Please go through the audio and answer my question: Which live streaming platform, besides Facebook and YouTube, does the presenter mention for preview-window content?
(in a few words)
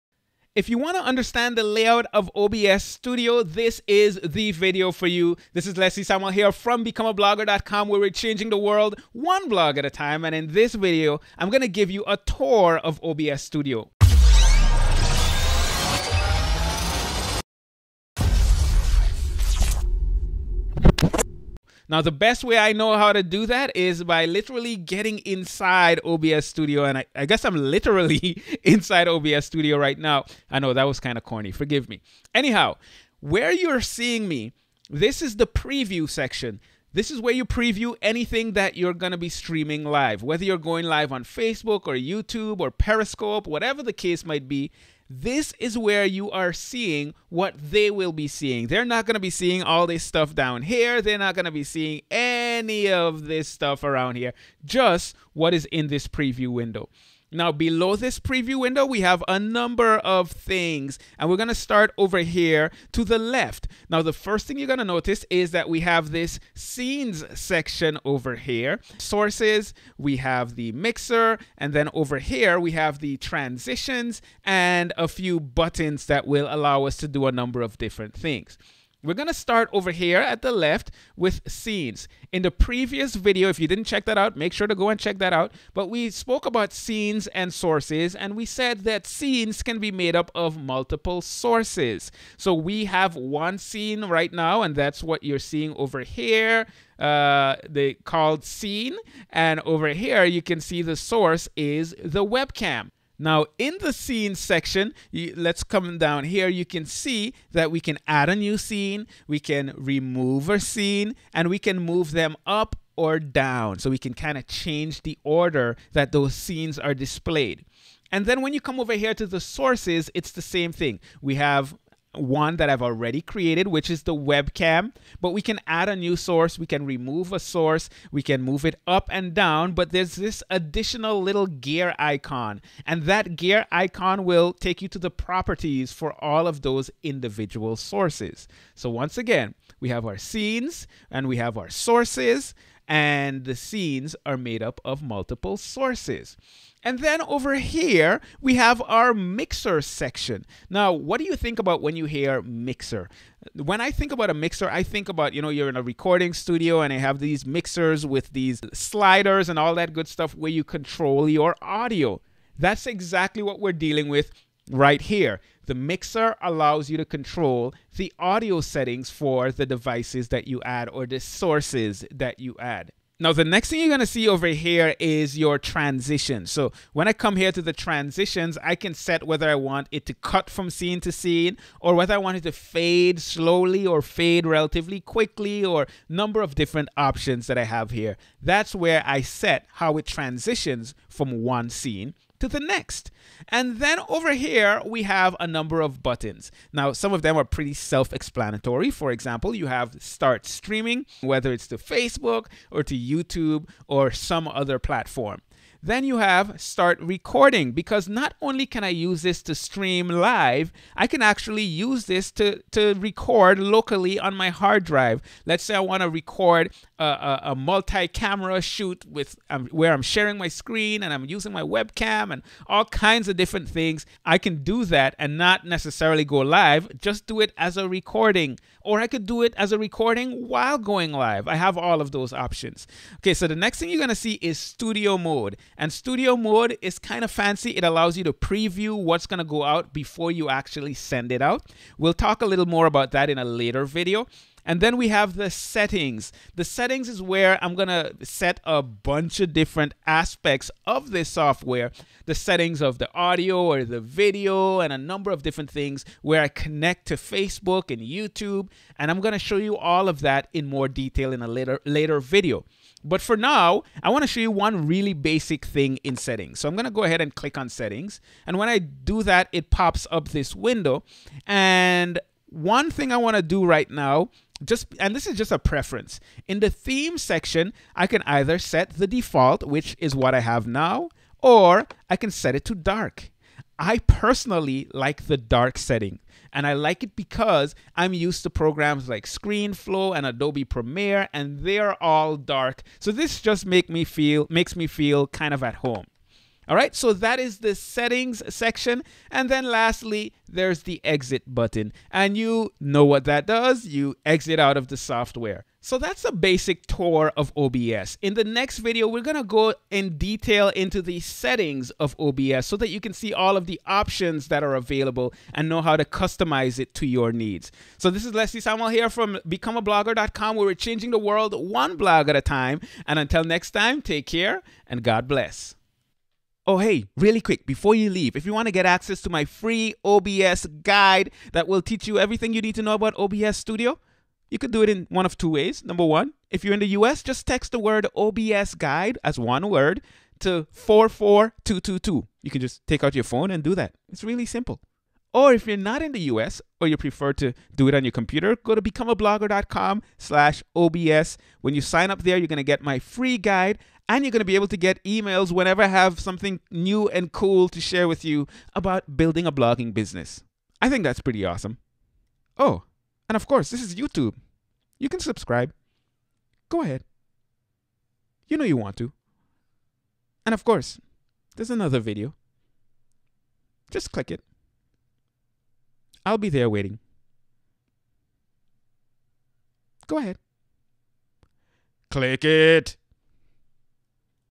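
Periscope.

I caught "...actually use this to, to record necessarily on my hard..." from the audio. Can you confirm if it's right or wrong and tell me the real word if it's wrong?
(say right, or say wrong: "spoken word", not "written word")
wrong: "locally", not "necessarily".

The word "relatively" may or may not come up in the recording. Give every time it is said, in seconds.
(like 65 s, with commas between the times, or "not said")
184 s.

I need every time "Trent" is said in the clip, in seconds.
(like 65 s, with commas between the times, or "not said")
not said.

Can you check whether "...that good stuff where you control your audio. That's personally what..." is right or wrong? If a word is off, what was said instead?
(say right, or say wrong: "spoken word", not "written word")
wrong: "exactly", not "personally".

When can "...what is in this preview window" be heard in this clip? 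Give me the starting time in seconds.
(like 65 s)
55 s.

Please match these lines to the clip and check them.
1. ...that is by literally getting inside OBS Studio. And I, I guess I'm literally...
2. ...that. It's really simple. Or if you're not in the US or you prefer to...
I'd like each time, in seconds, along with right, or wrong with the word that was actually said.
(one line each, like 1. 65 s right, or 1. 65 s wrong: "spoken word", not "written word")
1. 23 s right
2. 343 s right.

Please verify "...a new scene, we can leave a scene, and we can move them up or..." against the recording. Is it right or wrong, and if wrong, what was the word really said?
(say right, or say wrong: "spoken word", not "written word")
wrong: "remove", not "leave".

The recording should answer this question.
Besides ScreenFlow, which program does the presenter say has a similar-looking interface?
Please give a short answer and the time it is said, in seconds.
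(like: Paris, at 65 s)
Adobe Premiere, at 290 s.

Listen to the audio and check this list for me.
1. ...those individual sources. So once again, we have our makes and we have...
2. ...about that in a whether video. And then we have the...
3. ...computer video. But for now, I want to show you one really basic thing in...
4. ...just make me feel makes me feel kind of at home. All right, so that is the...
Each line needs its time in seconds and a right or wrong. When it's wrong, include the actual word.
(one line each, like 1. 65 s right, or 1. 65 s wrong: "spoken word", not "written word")
1. 136 s wrong: "scenes", not "makes"
2. 242 s wrong: "later", not "whether"
3. 261 s wrong: "later", not "computer"
4. 293 s right.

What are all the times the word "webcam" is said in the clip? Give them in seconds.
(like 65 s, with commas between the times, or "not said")
102 s, 124 s, 221 s.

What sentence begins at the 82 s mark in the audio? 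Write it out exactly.
In the previous video, if you didn't check that out, make sure to go and check that out.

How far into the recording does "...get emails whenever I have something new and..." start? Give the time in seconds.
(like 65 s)
354 s.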